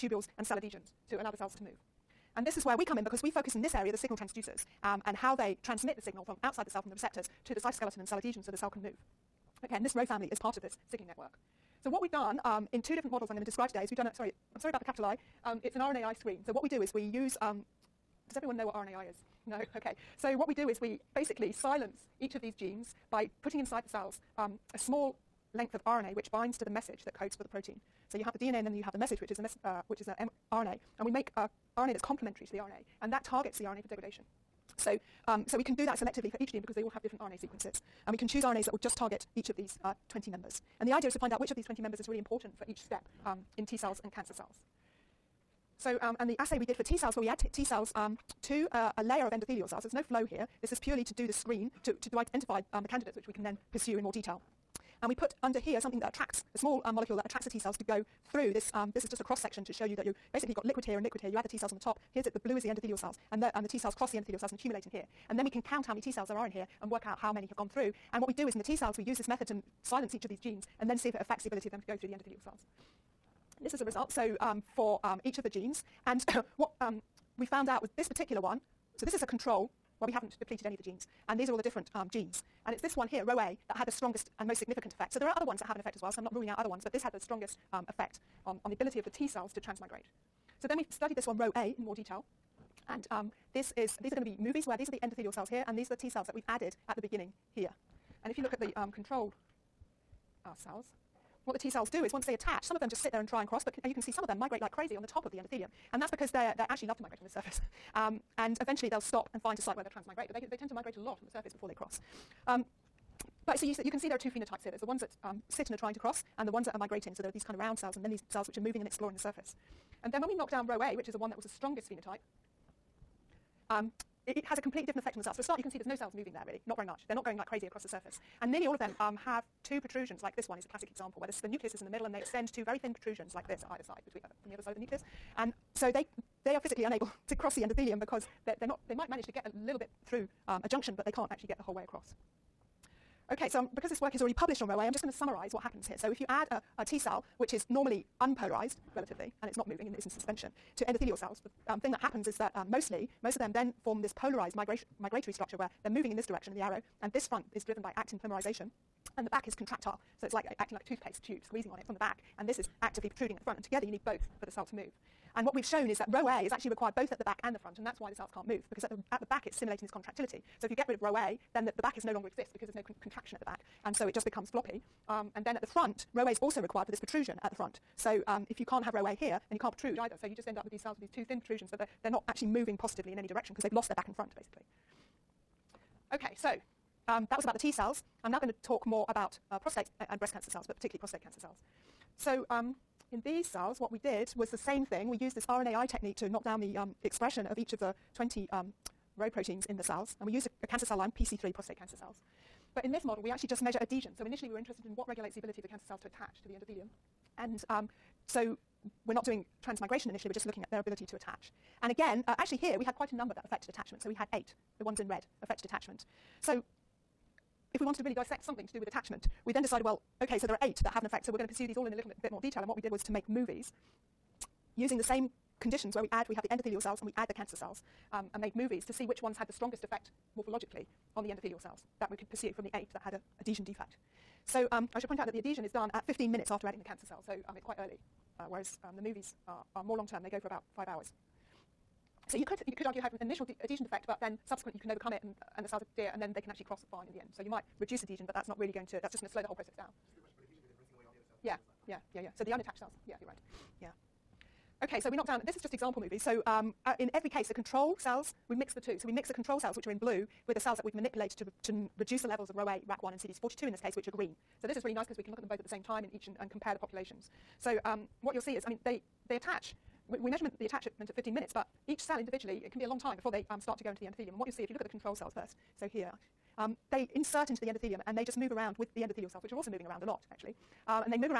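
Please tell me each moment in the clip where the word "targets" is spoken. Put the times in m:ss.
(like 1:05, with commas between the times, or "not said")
0:33, 0:38.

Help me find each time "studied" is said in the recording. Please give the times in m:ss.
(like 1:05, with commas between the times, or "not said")
1:30.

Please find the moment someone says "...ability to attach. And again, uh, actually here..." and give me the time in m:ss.
3:30.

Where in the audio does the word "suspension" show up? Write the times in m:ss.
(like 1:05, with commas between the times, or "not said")
2:30.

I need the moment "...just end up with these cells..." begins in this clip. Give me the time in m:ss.
3:00.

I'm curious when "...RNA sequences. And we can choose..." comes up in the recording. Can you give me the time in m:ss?
0:37.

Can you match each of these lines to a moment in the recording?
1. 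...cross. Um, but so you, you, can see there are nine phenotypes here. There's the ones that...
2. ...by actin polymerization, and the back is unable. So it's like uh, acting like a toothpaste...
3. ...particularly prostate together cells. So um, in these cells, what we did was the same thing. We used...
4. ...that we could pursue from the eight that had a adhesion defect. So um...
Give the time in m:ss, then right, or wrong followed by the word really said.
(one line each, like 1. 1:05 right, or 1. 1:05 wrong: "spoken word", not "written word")
1. 1:51 wrong: "two", not "nine"
2. 2:37 wrong: "contractile", not "unable"
3. 3:10 wrong: "cancer", not "together"
4. 3:52 right.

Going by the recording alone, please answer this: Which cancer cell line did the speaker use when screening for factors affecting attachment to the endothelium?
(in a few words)
PC3.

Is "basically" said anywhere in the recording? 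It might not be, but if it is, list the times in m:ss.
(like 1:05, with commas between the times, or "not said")
0:21, 1:00, 3:04.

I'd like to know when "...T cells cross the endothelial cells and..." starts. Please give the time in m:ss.
1:03.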